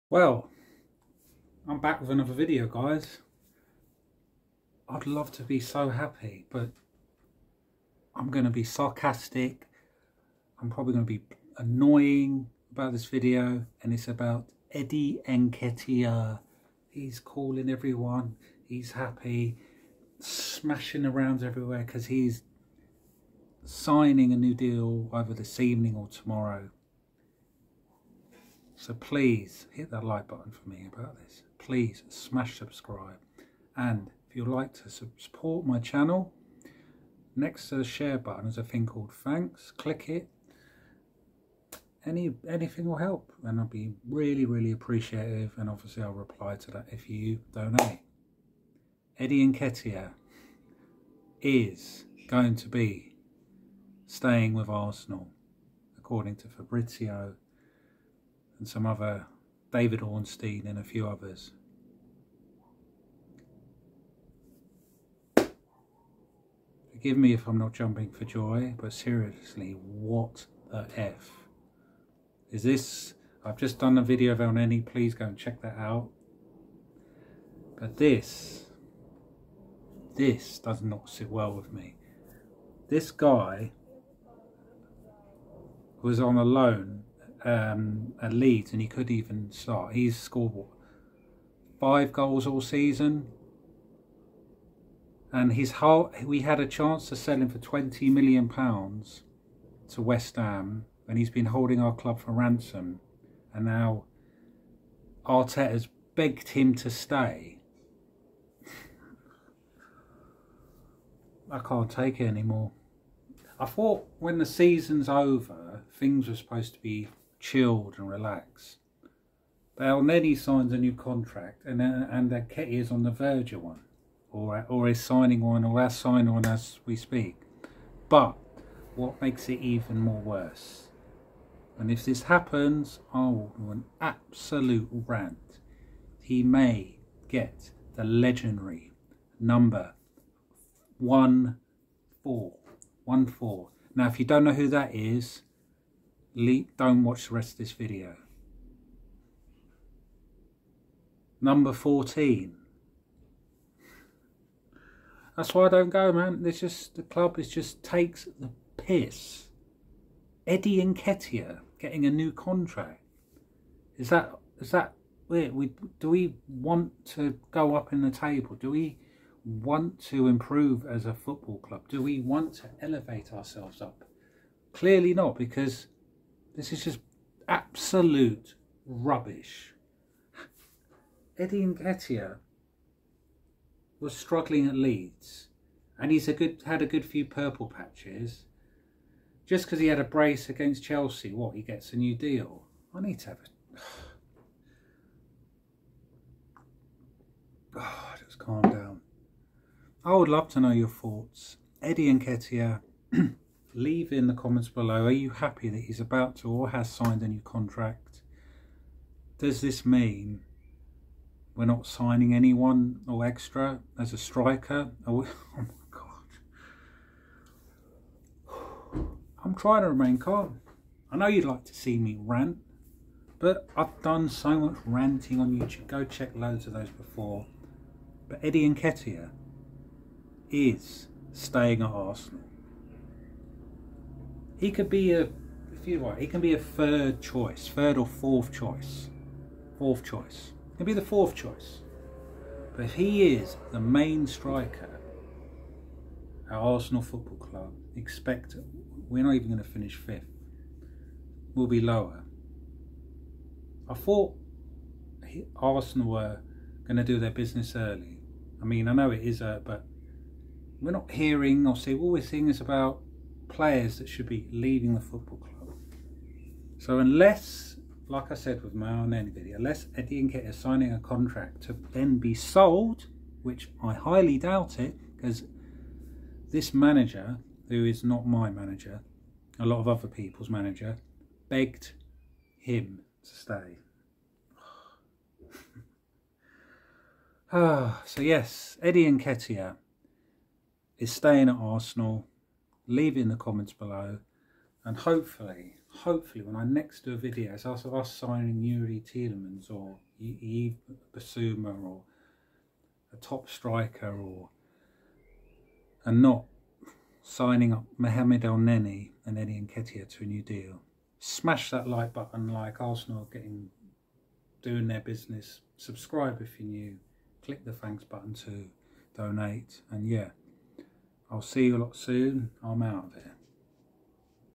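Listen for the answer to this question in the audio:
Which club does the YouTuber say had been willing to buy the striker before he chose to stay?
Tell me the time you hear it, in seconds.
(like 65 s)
100 s.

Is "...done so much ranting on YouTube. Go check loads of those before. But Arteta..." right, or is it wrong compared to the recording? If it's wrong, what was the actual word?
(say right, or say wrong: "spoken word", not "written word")
wrong: "Eddie", not "Arteta".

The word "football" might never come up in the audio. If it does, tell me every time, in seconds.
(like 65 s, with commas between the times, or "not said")
171 s, 247 s, 265 s.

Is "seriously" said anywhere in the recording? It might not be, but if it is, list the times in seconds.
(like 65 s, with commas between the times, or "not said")
68 s.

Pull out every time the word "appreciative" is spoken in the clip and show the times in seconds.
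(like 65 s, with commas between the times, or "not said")
44 s.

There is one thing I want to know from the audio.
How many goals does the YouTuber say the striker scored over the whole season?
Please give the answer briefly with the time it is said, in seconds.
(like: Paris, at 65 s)
5, at 91 s.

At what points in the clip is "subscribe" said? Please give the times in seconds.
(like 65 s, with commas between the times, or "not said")
32 s, 315 s.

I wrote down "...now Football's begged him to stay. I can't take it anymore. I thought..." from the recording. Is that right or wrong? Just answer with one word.
wrong.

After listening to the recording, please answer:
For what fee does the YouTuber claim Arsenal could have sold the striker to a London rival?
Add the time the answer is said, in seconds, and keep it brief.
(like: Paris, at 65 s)
20 million pounds, at 97 s.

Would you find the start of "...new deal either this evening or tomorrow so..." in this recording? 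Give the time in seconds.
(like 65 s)
24 s.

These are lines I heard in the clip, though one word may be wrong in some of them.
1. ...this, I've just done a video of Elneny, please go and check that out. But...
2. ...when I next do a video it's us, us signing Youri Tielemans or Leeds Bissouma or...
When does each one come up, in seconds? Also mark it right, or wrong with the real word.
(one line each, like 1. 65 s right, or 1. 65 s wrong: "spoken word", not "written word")
1. 72 s right
2. 296 s wrong: "Yves", not "Leeds".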